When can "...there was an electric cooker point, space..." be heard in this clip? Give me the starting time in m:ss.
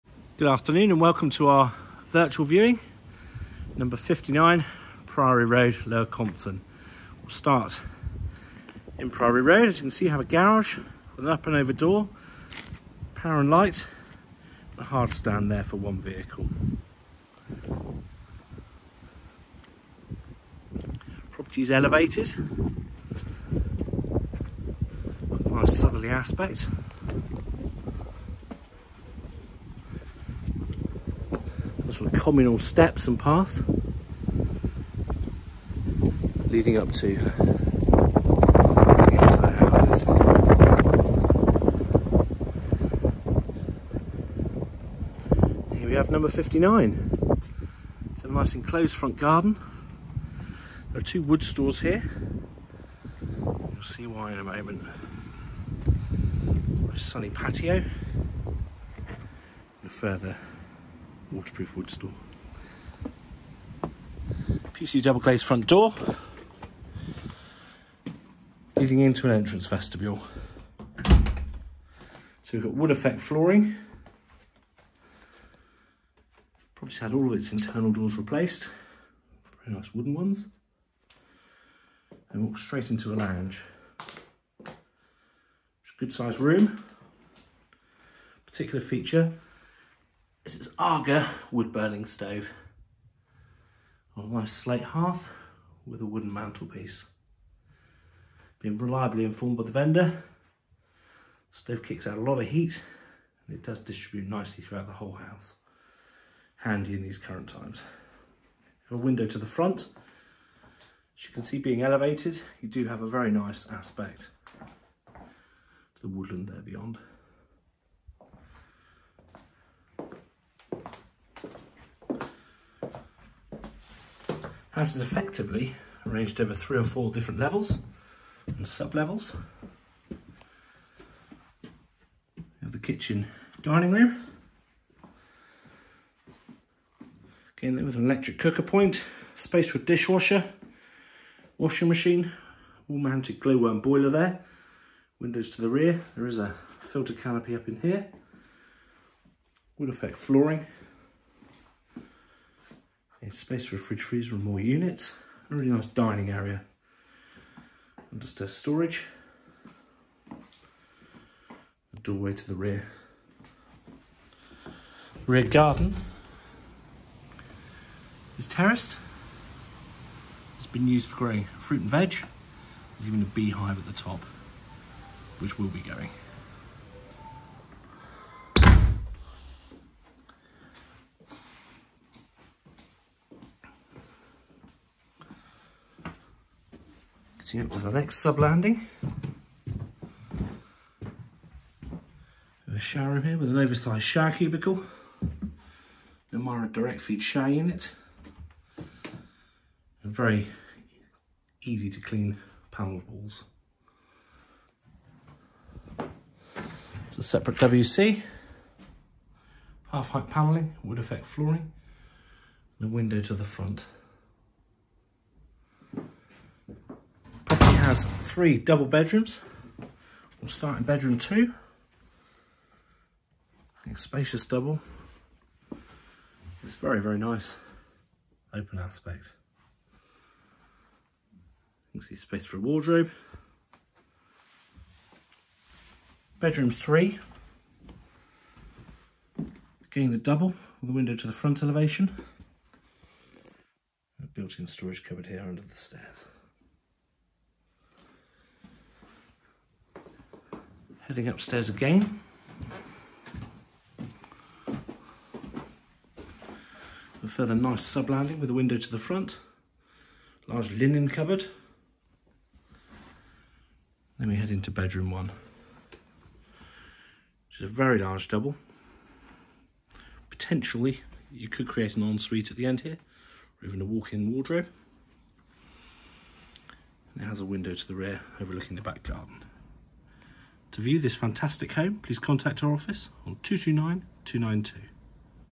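2:17.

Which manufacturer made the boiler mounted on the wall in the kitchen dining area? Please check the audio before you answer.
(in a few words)
Glow-worm.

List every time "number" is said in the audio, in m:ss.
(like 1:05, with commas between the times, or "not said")
0:03, 0:46.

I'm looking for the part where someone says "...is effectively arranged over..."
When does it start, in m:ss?
2:04.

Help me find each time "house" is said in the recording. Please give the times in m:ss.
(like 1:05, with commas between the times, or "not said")
1:45, 2:04.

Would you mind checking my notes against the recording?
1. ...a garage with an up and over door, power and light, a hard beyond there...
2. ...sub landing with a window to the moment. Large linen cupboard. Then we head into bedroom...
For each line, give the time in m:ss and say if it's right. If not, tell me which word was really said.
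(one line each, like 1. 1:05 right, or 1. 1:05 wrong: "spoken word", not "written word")
1. 0:10 wrong: "stand", not "beyond"
2. 4:17 wrong: "front", not "moment".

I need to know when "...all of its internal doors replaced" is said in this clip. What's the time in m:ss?
1:17.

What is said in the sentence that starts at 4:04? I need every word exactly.
Built-in storage cupboard here under the stairs.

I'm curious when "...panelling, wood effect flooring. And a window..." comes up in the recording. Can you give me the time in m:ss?
3:30.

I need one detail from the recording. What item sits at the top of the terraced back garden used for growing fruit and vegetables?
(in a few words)
A beehive.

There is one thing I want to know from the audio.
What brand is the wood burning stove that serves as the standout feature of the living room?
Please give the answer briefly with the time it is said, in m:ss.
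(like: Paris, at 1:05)
Aga, at 1:30.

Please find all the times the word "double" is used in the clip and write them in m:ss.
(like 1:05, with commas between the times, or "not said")
1:05, 3:38, 3:44, 4:00, 4:28.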